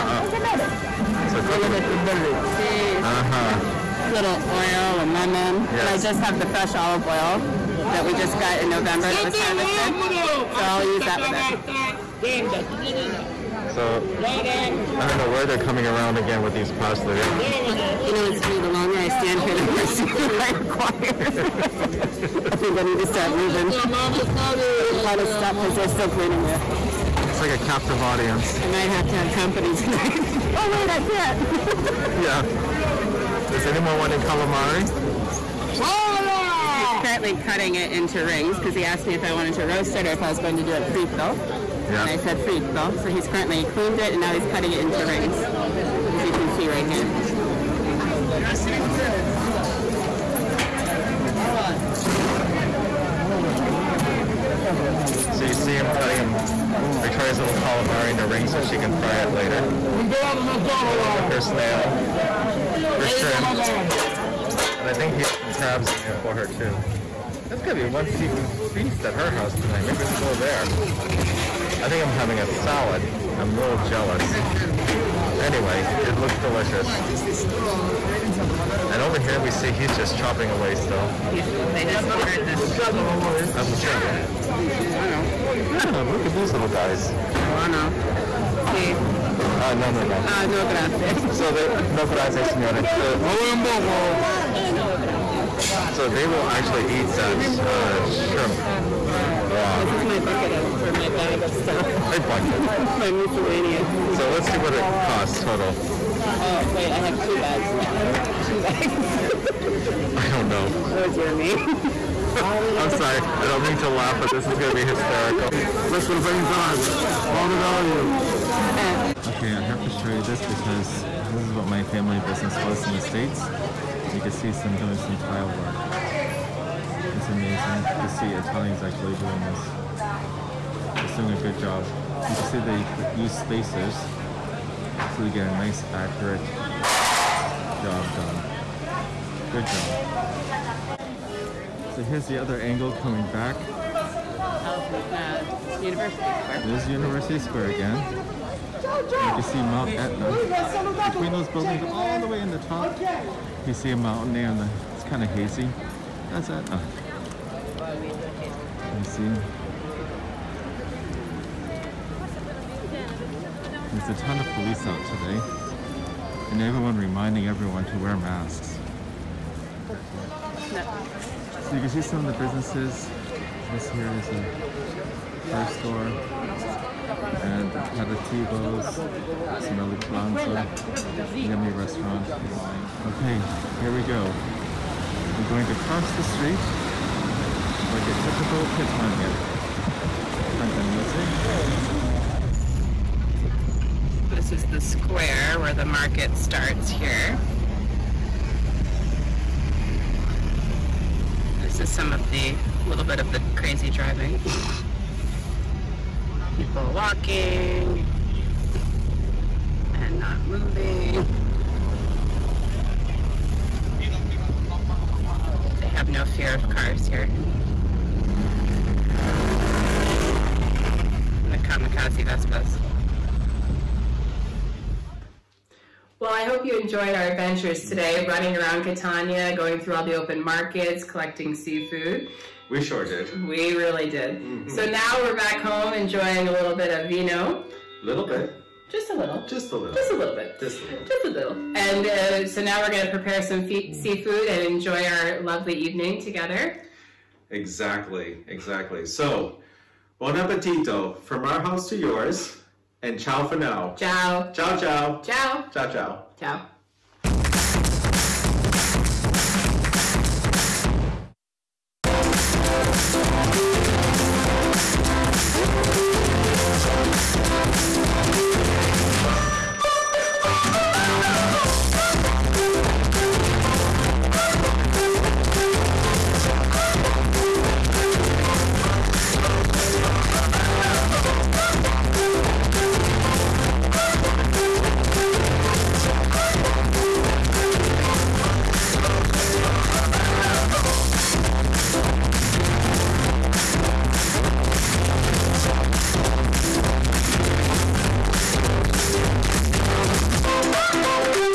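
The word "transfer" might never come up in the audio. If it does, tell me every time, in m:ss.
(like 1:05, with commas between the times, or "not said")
not said.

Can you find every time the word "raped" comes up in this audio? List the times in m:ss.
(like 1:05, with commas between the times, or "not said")
not said.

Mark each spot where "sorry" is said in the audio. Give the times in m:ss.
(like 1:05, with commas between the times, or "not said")
1:52.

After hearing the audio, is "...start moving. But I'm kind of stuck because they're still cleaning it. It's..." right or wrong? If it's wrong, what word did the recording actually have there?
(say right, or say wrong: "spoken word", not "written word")
right.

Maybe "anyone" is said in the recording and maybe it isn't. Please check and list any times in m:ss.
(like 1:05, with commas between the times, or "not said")
0:33.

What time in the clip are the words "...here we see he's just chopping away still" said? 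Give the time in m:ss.
1:19.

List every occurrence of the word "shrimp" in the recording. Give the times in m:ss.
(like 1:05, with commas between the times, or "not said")
1:03, 1:38.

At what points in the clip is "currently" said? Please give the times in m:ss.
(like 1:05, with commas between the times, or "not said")
0:37, 0:43.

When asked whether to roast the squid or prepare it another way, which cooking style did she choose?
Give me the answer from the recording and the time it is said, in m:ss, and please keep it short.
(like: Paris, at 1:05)
fritto, at 0:42.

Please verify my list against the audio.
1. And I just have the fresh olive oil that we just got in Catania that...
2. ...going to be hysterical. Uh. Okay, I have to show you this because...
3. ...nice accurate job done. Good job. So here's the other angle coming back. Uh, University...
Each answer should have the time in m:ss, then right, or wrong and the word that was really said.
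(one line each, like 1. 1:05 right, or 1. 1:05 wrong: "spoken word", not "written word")
1. 0:05 wrong: "November", not "Catania"
2. 1:54 right
3. 2:15 right.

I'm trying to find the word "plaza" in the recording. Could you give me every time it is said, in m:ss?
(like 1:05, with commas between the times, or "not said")
3:00.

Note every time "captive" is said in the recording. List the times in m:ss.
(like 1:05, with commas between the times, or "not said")
0:27.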